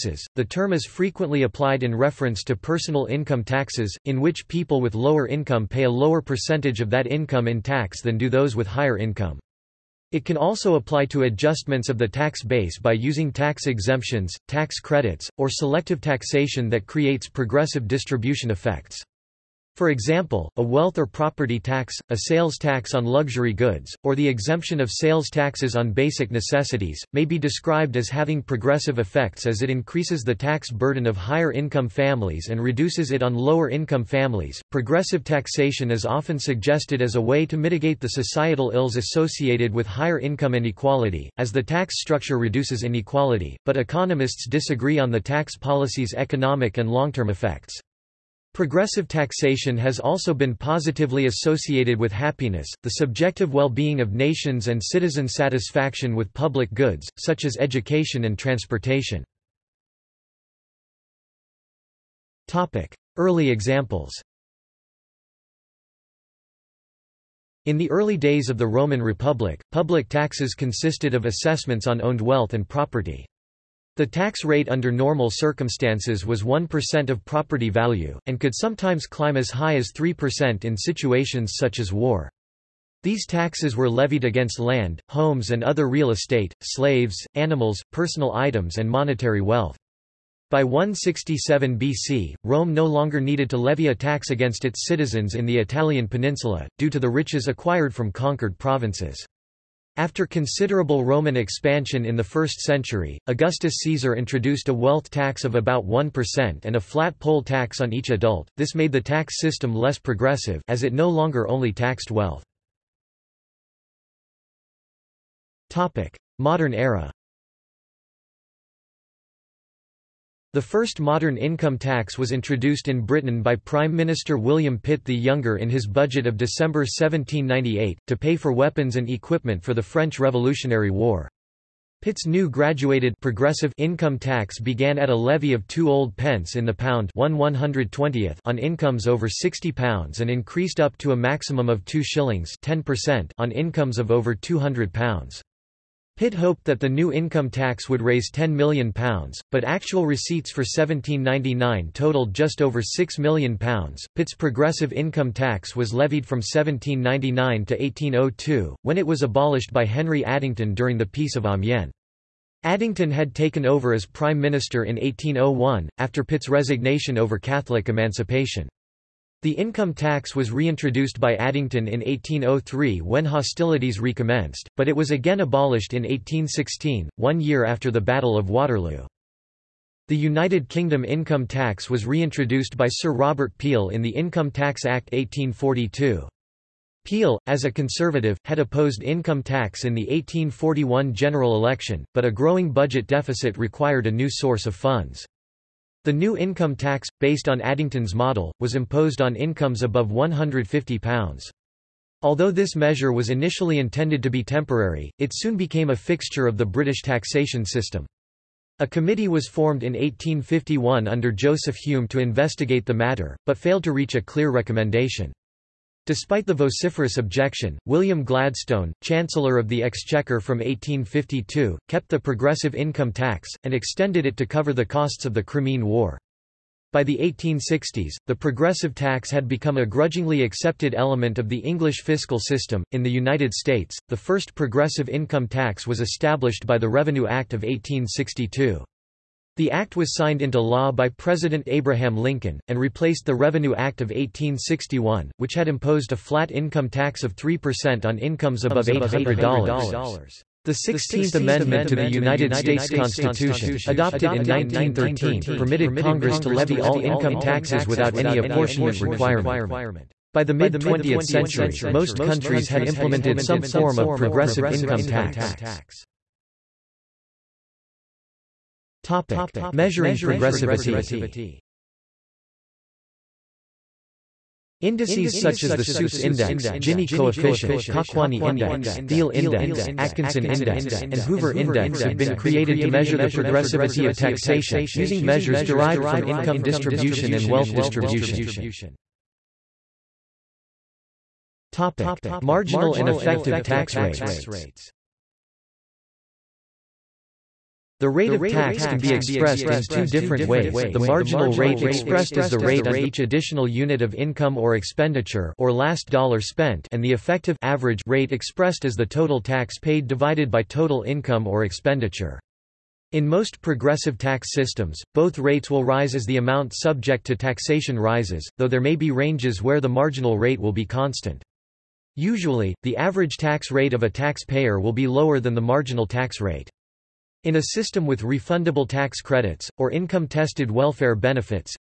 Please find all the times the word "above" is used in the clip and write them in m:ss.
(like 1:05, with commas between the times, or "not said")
3:19, 4:08.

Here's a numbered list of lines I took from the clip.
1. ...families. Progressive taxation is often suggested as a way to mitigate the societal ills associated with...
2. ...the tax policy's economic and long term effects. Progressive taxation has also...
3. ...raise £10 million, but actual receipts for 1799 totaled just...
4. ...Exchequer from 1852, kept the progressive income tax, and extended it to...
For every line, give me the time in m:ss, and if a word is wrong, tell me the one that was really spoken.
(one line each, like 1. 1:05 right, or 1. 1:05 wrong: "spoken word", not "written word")
1. 0:34 right
2. 0:45 right
3. 2:28 right
4. 3:39 right.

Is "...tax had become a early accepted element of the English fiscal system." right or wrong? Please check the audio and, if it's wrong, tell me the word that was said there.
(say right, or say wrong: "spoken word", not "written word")
wrong: "grudgingly", not "early".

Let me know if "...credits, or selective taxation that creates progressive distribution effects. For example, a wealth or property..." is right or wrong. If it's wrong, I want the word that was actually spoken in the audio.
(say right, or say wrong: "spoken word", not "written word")
right.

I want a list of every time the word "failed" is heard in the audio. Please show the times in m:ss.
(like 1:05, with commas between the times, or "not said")
3:33.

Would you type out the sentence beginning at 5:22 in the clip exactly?
Usually, the average tax rate of a taxpayer will be lower than the marginal tax rate.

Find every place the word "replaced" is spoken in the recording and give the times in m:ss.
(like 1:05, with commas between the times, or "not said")
4:02.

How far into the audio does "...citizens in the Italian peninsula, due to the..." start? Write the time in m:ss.
1:34.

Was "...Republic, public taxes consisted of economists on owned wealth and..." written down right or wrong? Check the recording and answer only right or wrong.
wrong.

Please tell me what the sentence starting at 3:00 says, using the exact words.
The United Kingdom income tax was reintroduced by Sir Robert Peel in the Income Tax Act 1842.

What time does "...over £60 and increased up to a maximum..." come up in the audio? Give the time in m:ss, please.
2:19.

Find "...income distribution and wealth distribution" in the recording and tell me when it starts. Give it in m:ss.
4:46.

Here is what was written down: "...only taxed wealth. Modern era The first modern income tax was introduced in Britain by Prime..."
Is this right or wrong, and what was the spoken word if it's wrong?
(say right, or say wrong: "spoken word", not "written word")
right.